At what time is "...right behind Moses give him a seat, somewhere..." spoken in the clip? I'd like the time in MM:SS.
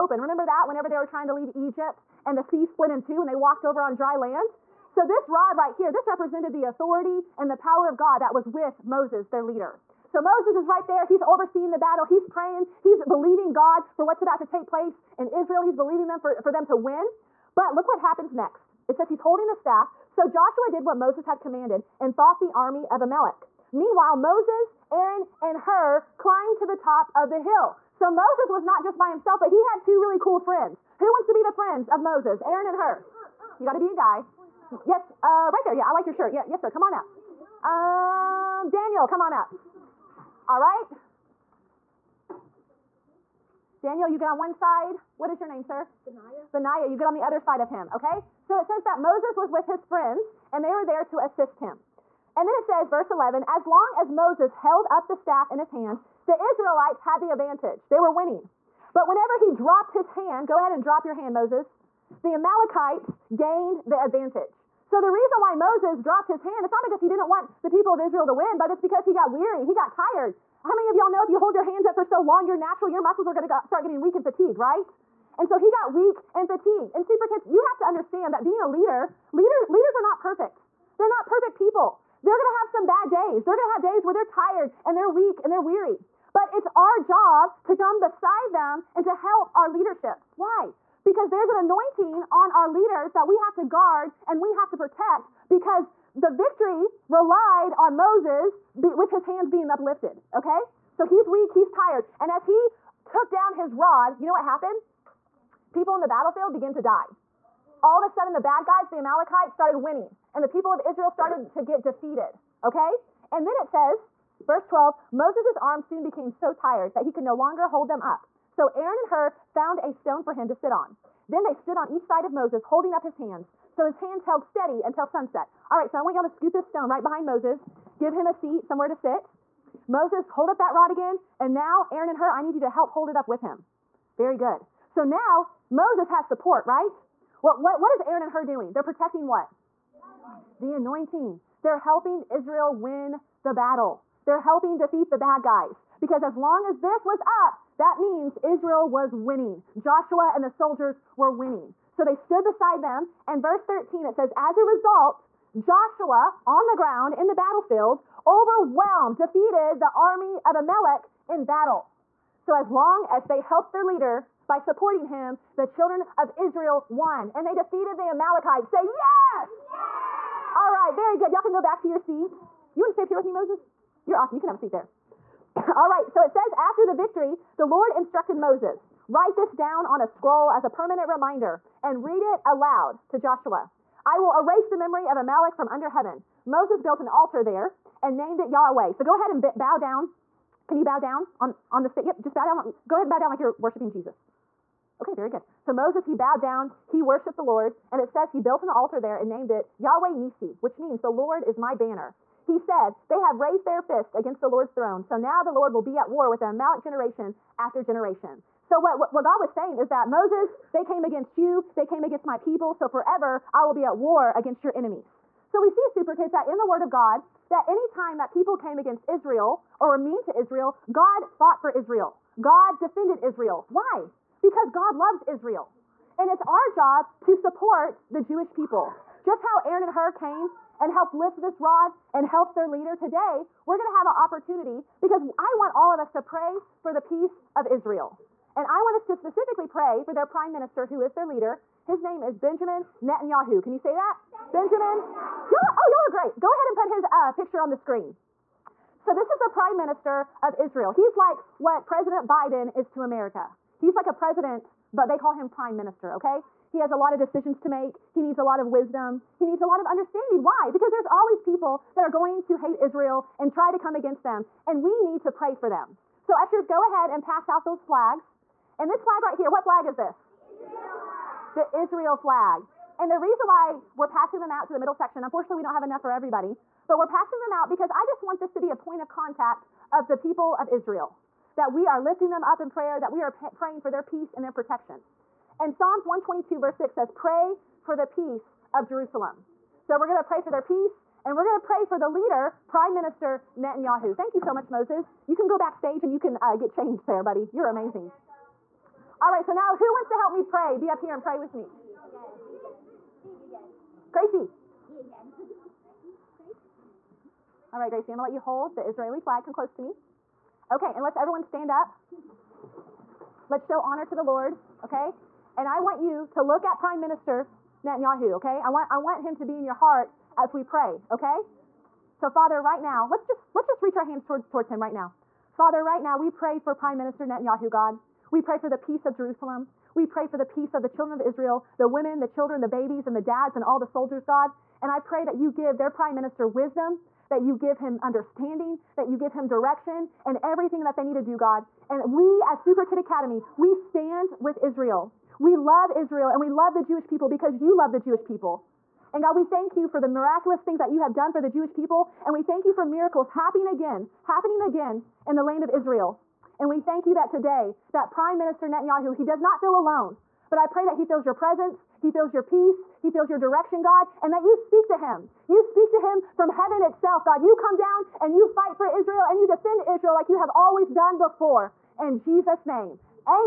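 02:06.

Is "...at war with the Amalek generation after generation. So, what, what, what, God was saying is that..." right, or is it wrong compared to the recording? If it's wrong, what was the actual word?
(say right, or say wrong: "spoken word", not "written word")
right.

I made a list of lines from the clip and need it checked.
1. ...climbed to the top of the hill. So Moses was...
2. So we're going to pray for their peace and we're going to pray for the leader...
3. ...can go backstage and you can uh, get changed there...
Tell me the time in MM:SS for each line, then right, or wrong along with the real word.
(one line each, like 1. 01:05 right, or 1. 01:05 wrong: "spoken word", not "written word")
1. 00:26 right
2. 04:49 right
3. 04:55 right.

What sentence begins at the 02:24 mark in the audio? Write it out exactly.
They're helping defeat the bad guys.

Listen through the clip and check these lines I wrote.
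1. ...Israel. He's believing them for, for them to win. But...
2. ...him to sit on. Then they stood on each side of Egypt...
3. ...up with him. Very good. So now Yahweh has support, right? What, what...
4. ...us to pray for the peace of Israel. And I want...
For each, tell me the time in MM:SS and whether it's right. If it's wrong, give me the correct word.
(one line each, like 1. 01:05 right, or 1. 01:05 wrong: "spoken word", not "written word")
1. 00:15 right
2. 02:00 wrong: "Moses", not "Egypt"
3. 02:13 wrong: "Moses", not "Yahweh"
4. 03:55 right.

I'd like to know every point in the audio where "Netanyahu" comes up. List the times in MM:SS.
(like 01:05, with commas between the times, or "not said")
04:03, 04:53, 05:17, 05:27, 05:58.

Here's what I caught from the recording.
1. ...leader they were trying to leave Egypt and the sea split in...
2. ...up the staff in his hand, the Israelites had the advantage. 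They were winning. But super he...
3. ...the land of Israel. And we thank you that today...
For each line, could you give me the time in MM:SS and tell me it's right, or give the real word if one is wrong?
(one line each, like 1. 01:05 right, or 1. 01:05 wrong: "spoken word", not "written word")
1. 00:00 wrong: "whenever", not "leader"
2. 00:54 wrong: "whenever", not "super"
3. 05:55 right.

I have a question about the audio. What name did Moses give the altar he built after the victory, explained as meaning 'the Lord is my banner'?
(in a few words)
Yahweh Nisi.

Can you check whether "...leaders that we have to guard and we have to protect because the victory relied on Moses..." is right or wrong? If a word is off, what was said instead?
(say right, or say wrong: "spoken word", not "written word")
right.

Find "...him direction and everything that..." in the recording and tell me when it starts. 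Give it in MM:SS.
05:39.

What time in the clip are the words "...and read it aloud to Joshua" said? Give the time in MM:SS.
03:01.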